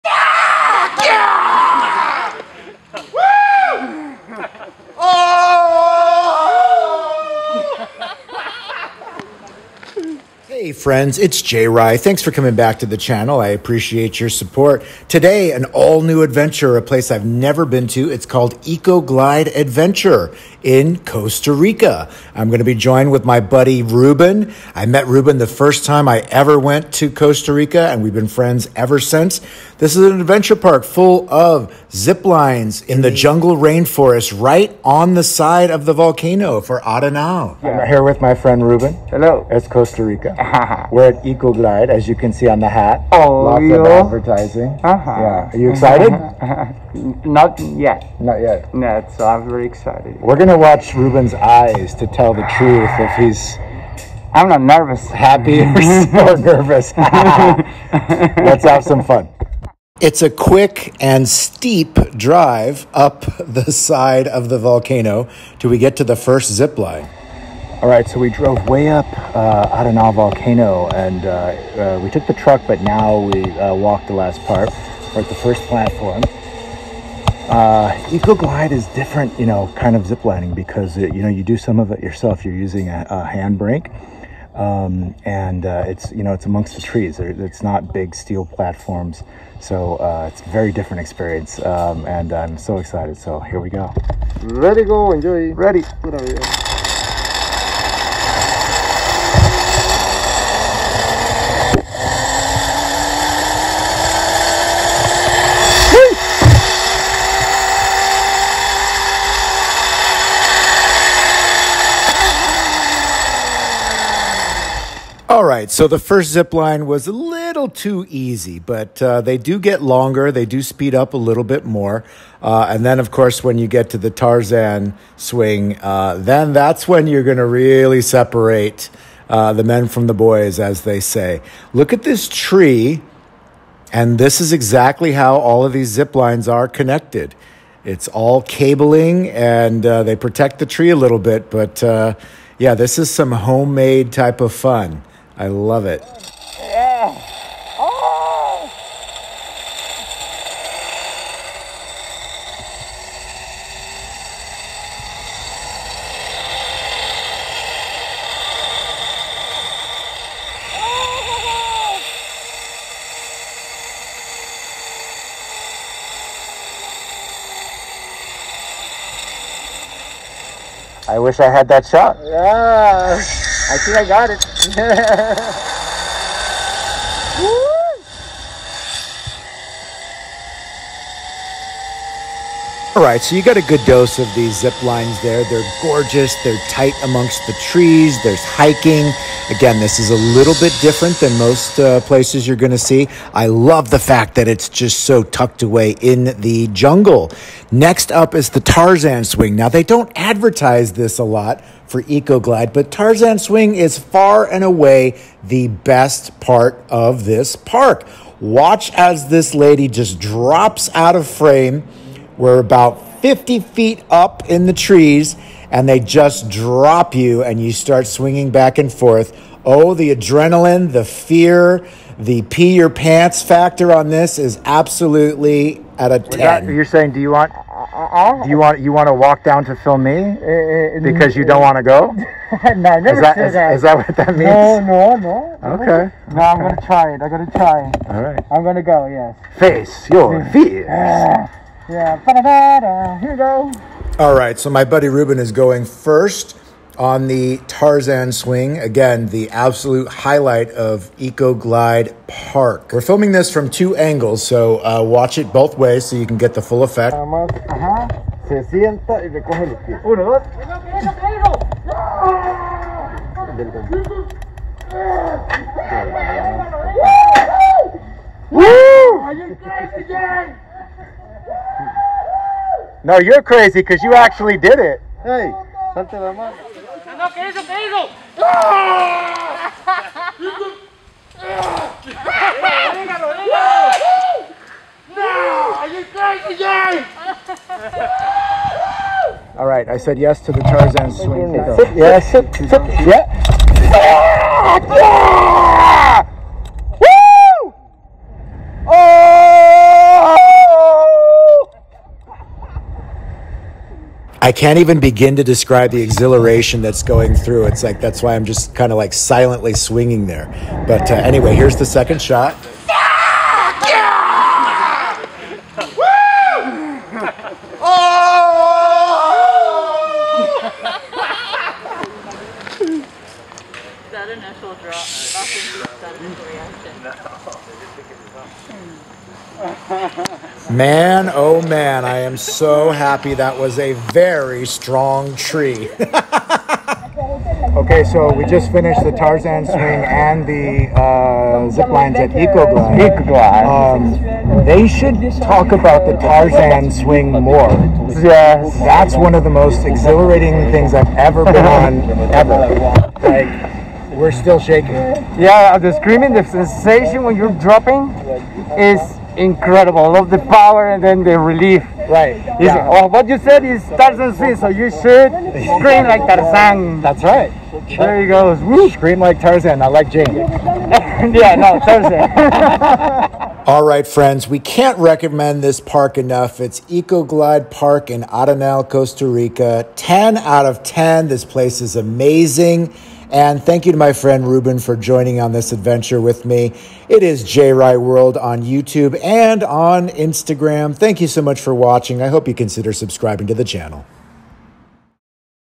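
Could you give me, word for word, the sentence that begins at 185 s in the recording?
They're gorgeous, they're tight amongst the trees, there's hiking.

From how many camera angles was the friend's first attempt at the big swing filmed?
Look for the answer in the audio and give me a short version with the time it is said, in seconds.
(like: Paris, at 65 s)
2, at 253 s.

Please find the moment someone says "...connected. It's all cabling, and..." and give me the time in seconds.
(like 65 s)
136 s.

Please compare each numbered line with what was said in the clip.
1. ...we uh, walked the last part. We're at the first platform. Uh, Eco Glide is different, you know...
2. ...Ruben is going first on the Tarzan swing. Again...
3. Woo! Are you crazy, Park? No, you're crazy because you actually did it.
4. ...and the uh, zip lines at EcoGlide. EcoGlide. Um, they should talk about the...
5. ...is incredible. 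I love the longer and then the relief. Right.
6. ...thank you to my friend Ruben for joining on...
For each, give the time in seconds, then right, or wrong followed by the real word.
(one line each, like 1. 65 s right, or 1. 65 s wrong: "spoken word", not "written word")
1. 73 s right
2. 245 s right
3. 268 s wrong: "Jay", not "Park"
4. 340 s right
5. 358 s wrong: "power", not "longer"
6. 383 s right.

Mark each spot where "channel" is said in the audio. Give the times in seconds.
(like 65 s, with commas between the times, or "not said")
12 s, 393 s.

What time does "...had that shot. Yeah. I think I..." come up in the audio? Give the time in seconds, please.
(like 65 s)
171 s.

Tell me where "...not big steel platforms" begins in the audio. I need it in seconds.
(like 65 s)
87 s.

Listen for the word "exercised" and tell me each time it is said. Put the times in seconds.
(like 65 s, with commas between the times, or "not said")
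not said.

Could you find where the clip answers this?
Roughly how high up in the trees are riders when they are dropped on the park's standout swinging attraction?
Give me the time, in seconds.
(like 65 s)
213 s.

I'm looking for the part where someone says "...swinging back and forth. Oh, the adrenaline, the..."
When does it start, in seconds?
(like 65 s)
218 s.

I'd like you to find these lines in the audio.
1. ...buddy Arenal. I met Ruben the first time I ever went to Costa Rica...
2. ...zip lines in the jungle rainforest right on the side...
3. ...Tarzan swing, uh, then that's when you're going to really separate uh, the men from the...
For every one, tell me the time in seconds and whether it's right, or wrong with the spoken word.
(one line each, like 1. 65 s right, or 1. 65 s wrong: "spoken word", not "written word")
1. 23 s wrong: "Ruben", not "Arenal"
2. 31 s right
3. 124 s right.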